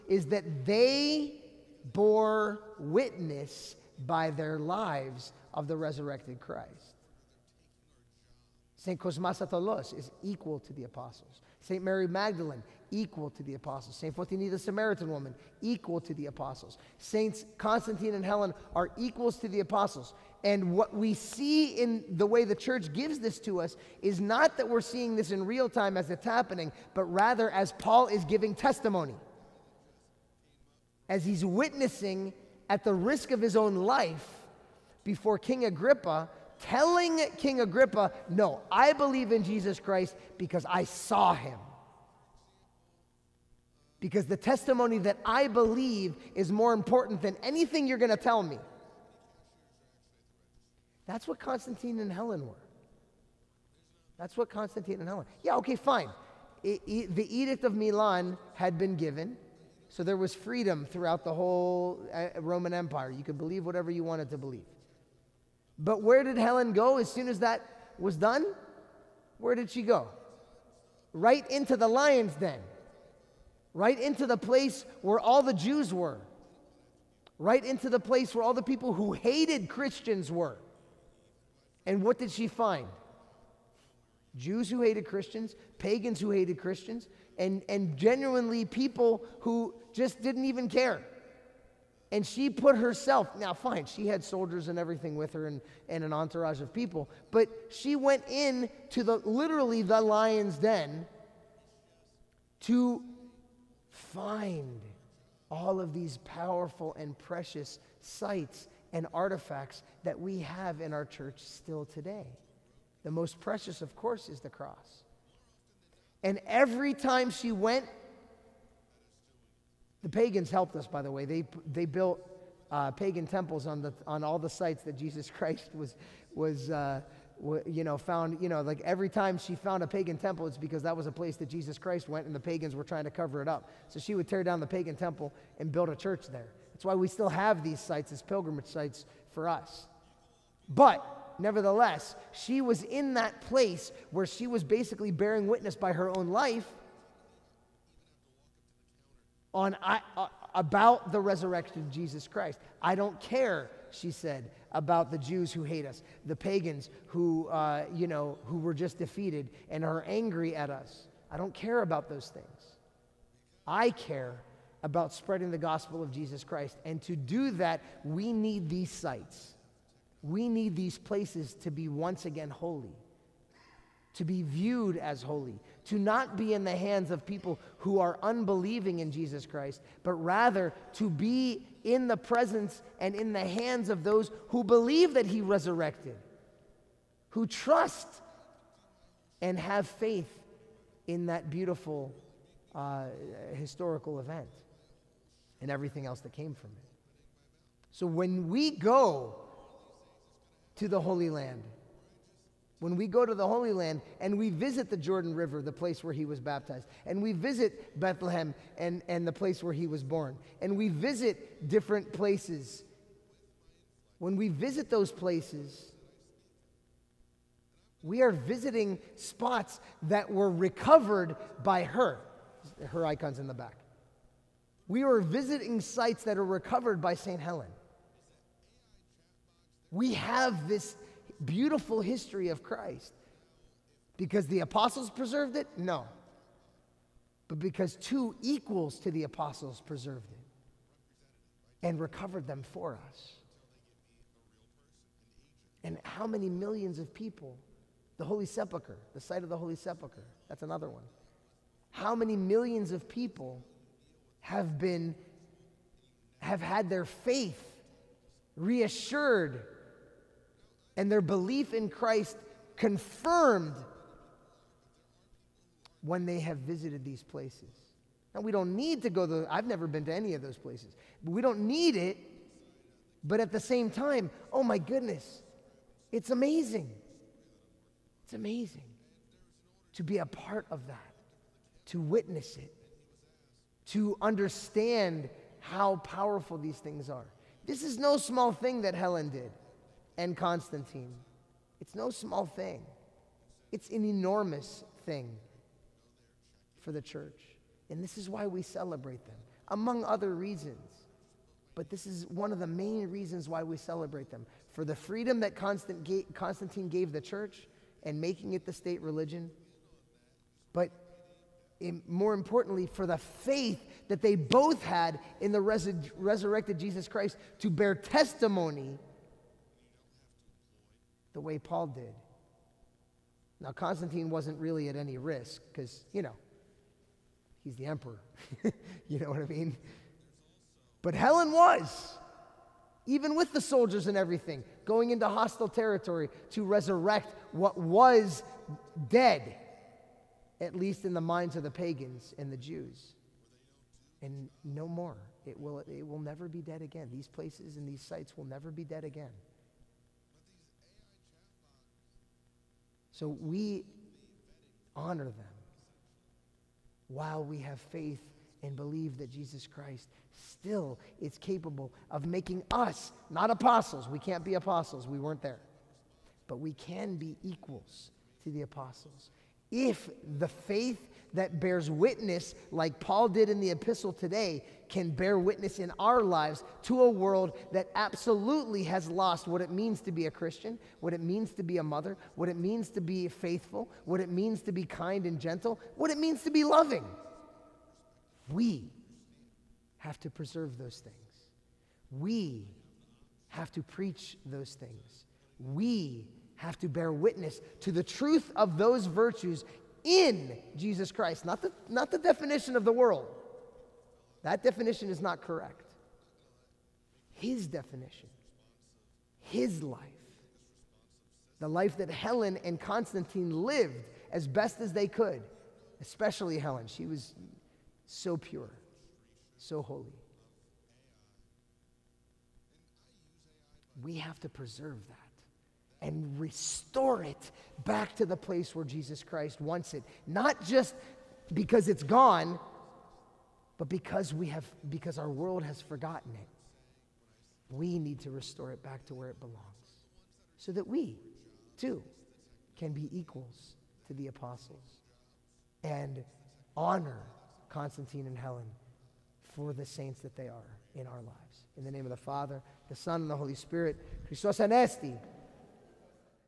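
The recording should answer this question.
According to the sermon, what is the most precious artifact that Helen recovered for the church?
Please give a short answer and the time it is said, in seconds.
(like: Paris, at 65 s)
the cross, at 114 s.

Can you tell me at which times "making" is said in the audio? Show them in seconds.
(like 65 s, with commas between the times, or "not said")
308 s, 362 s.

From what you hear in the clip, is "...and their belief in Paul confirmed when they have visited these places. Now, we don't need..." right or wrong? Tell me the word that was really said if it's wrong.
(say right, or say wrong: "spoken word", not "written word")
wrong: "Christ", not "Paul".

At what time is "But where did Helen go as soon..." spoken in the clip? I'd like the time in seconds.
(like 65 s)
65 s.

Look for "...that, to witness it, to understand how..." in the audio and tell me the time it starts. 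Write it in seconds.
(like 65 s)
280 s.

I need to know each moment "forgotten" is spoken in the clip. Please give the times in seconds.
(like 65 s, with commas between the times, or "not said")
435 s.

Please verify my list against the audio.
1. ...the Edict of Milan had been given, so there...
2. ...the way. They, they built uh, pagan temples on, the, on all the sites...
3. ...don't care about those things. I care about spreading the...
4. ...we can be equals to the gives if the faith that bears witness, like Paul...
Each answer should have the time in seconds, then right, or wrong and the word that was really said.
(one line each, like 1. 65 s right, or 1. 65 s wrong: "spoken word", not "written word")
1. 57 s right
2. 121 s right
3. 161 s right
4. 366 s wrong: "apostles", not "gives".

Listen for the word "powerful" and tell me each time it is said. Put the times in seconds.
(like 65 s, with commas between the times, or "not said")
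106 s, 285 s.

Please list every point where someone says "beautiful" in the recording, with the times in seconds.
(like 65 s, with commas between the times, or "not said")
191 s, 231 s.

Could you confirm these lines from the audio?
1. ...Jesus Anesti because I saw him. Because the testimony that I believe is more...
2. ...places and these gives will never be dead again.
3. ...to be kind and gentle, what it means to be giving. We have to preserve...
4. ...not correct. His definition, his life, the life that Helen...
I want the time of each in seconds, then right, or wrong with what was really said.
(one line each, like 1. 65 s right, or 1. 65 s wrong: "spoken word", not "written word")
1. 39 s wrong: "Christ", not "Anesti"
2. 347 s wrong: "sites", not "gives"
3. 384 s wrong: "loving", not "giving"
4. 405 s right.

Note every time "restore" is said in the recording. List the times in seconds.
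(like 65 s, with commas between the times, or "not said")
426 s, 438 s.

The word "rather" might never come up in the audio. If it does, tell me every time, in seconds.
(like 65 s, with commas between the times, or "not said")
27 s, 180 s.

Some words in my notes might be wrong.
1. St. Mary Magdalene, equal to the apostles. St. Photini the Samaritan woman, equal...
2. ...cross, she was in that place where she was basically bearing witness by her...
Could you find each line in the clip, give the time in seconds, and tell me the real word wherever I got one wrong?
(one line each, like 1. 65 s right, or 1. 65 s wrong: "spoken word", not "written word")
1. 11 s right
2. 141 s wrong: "nevertheless", not "cross".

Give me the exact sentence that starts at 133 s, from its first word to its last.
So she would tear down the pagan temple and build a church there.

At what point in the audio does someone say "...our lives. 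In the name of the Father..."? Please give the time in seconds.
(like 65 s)
451 s.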